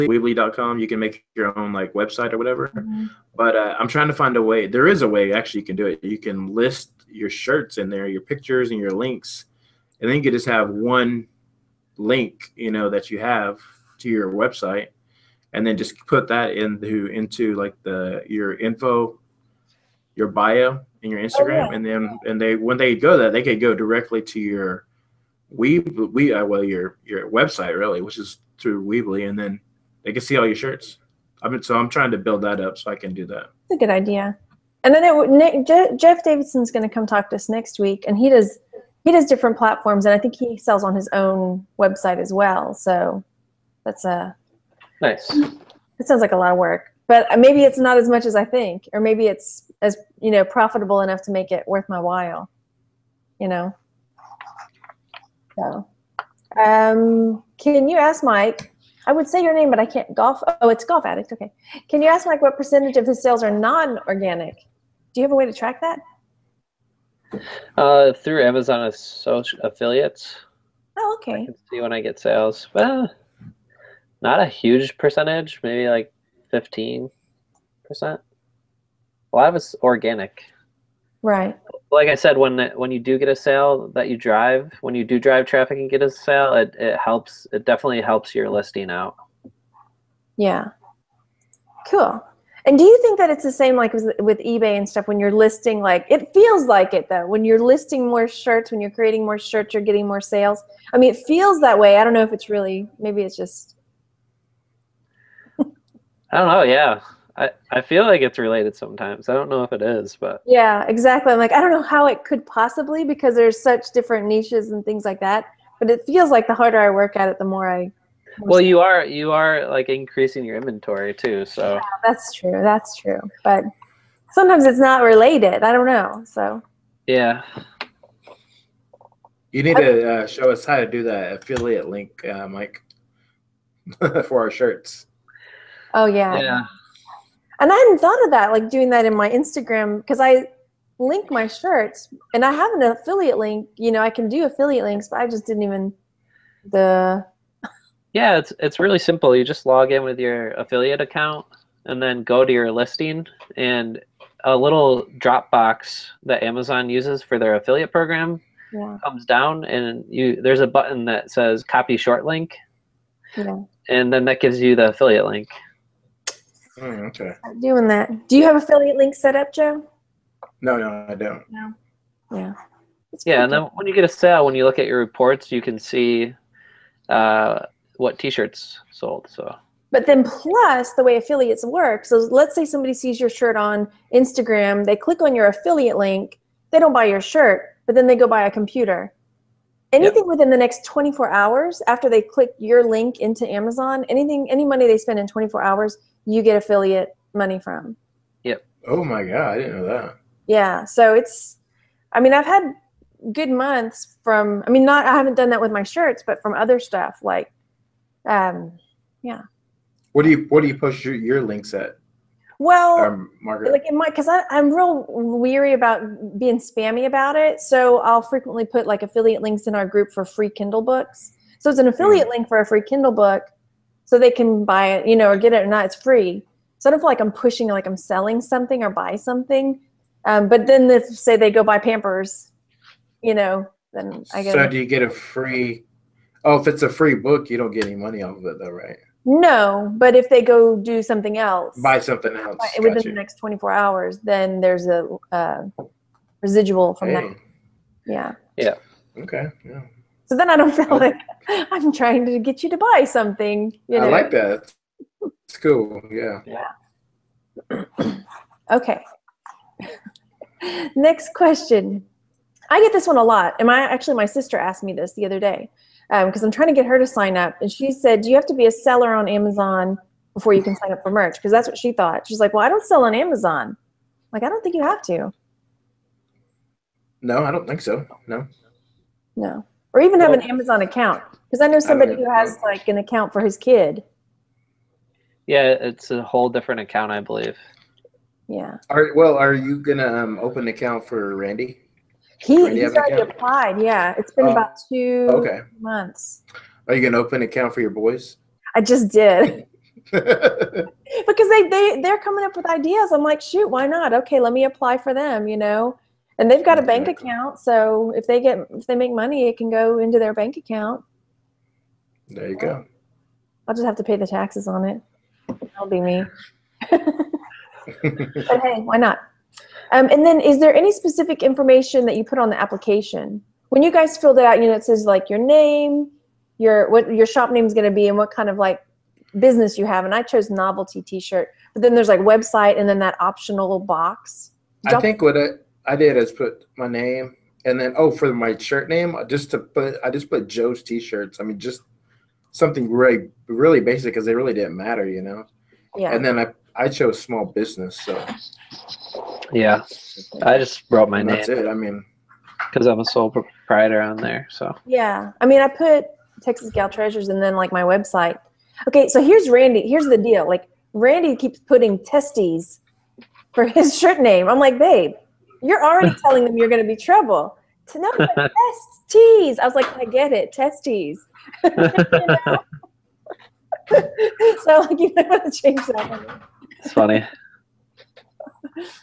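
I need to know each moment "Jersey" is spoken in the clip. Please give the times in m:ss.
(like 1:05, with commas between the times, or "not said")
not said.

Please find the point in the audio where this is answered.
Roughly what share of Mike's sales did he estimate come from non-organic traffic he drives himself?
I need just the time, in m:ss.
1:16.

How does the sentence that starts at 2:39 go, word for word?
comes down and you there's a button that says copy short link.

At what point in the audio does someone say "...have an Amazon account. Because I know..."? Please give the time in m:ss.
4:40.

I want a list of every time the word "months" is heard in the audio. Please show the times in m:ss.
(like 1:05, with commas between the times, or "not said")
3:23, 4:55.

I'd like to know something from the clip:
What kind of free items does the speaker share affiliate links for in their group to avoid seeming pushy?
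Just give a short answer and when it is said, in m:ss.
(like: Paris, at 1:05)
Kindle books, at 3:40.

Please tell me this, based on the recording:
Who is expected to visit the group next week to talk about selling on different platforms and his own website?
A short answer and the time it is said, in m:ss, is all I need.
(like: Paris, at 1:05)
Jeff Davidson, at 0:35.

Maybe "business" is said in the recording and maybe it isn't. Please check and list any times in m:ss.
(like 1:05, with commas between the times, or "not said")
5:29, 5:47.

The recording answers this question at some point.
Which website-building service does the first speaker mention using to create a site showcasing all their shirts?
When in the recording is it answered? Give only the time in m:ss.
0:00.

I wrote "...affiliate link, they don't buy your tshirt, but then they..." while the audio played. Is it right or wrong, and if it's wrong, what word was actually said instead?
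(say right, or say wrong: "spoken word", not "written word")
wrong: "shirt", not "tshirt".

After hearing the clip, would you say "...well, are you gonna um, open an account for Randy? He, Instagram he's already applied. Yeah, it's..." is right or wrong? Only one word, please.
wrong.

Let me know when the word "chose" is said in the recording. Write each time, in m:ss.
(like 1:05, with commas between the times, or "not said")
5:30, 5:46.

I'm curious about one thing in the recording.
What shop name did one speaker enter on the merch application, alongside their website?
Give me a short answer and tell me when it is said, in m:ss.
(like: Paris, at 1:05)
Texas Gal Treasures, at 5:56.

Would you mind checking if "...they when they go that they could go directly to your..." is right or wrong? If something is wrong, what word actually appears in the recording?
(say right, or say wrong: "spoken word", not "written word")
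right.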